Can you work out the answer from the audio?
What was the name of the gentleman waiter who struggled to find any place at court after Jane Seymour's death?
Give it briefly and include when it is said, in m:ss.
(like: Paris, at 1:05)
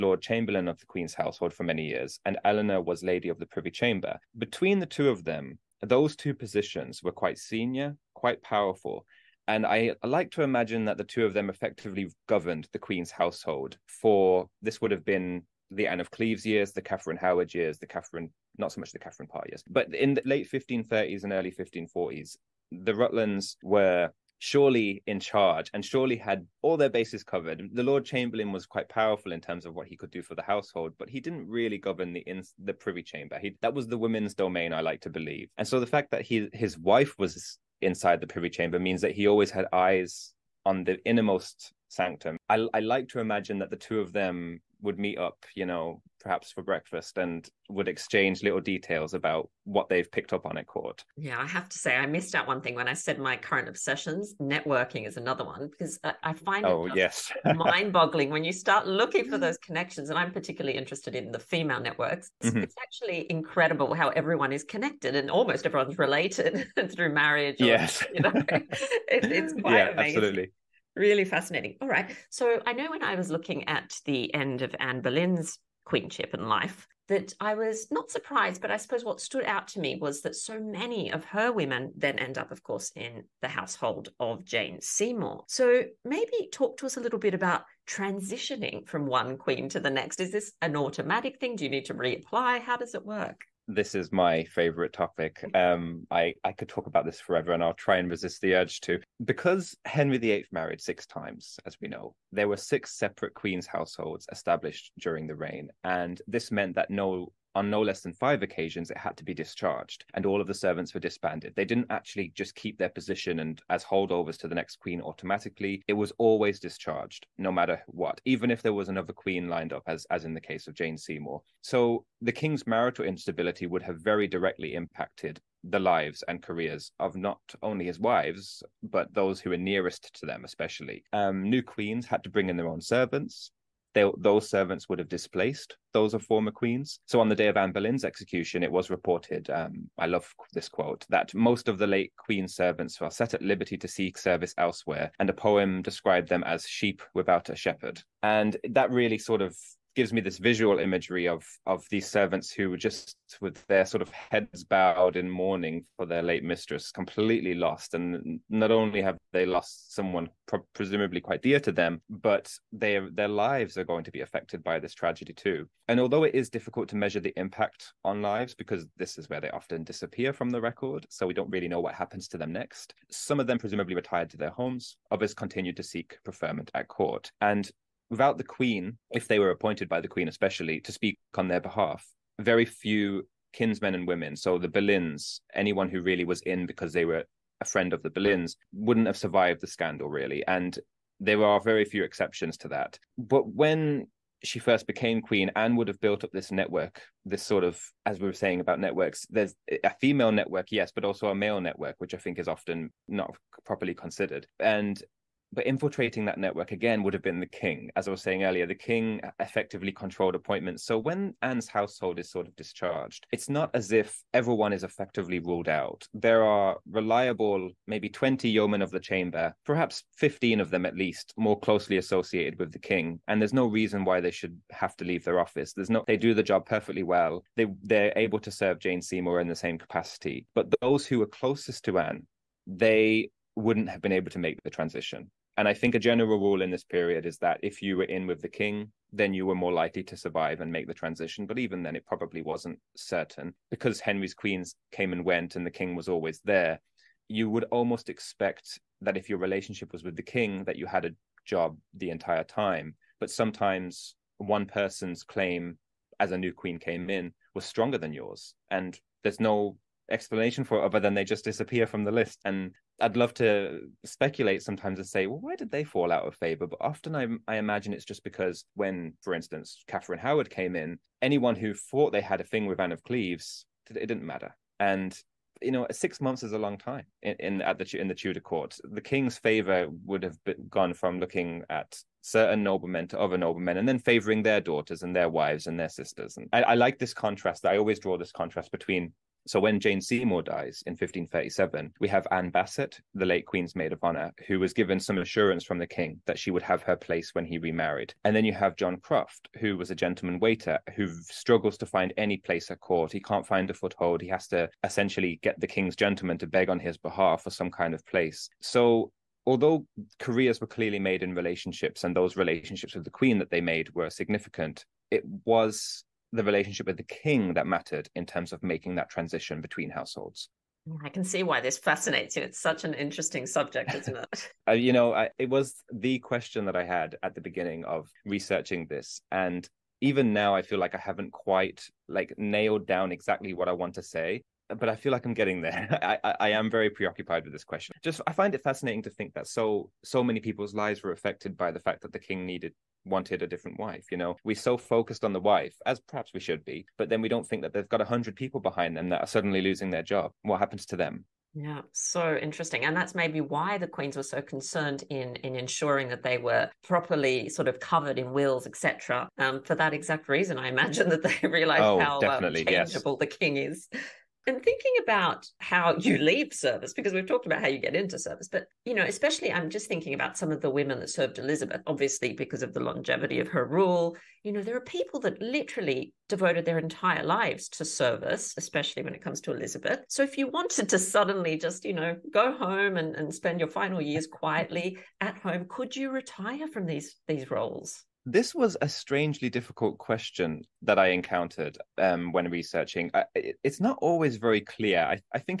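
John Croft, at 4:58.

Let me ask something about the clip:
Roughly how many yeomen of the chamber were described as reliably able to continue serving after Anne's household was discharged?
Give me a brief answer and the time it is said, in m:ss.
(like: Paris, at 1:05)
20, at 3:38.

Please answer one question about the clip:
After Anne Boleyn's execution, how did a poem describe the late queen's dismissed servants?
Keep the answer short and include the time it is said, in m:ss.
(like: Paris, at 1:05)
Sheep without a shepherd, at 2:26.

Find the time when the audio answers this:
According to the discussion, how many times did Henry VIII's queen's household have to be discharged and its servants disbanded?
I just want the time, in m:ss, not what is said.
1:48.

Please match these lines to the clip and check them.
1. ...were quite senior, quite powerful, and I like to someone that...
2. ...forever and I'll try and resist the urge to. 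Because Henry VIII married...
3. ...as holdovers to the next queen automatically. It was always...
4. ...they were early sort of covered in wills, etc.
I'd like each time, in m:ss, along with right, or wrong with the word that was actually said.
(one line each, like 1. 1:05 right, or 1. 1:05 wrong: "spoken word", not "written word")
1. 0:07 wrong: "imagine", not "someone"
2. 1:37 right
3. 1:53 right
4. 5:56 wrong: "properly", not "early".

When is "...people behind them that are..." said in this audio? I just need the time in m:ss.
5:48.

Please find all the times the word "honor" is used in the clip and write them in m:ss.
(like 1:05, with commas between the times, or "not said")
4:54.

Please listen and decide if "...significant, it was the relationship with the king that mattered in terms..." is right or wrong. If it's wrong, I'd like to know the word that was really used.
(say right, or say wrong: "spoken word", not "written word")
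right.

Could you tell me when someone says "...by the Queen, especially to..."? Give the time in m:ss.
2:59.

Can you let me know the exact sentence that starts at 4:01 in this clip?
But even then, it probably wasn't certain because Henry's queens came and went and the king was always there.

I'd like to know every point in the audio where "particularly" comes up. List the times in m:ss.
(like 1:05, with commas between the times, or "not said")
1:00.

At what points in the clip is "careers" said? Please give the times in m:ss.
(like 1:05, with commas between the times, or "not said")
2:06, 5:10.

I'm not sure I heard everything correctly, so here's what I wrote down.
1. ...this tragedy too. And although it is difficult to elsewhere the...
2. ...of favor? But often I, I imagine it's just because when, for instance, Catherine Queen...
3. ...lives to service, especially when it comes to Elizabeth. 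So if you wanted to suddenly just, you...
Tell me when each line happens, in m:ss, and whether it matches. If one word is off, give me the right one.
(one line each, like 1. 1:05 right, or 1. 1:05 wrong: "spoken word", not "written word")
1. 2:44 wrong: "measure", not "elsewhere"
2. 4:26 wrong: "Howard", not "Queen"
3. 6:17 right.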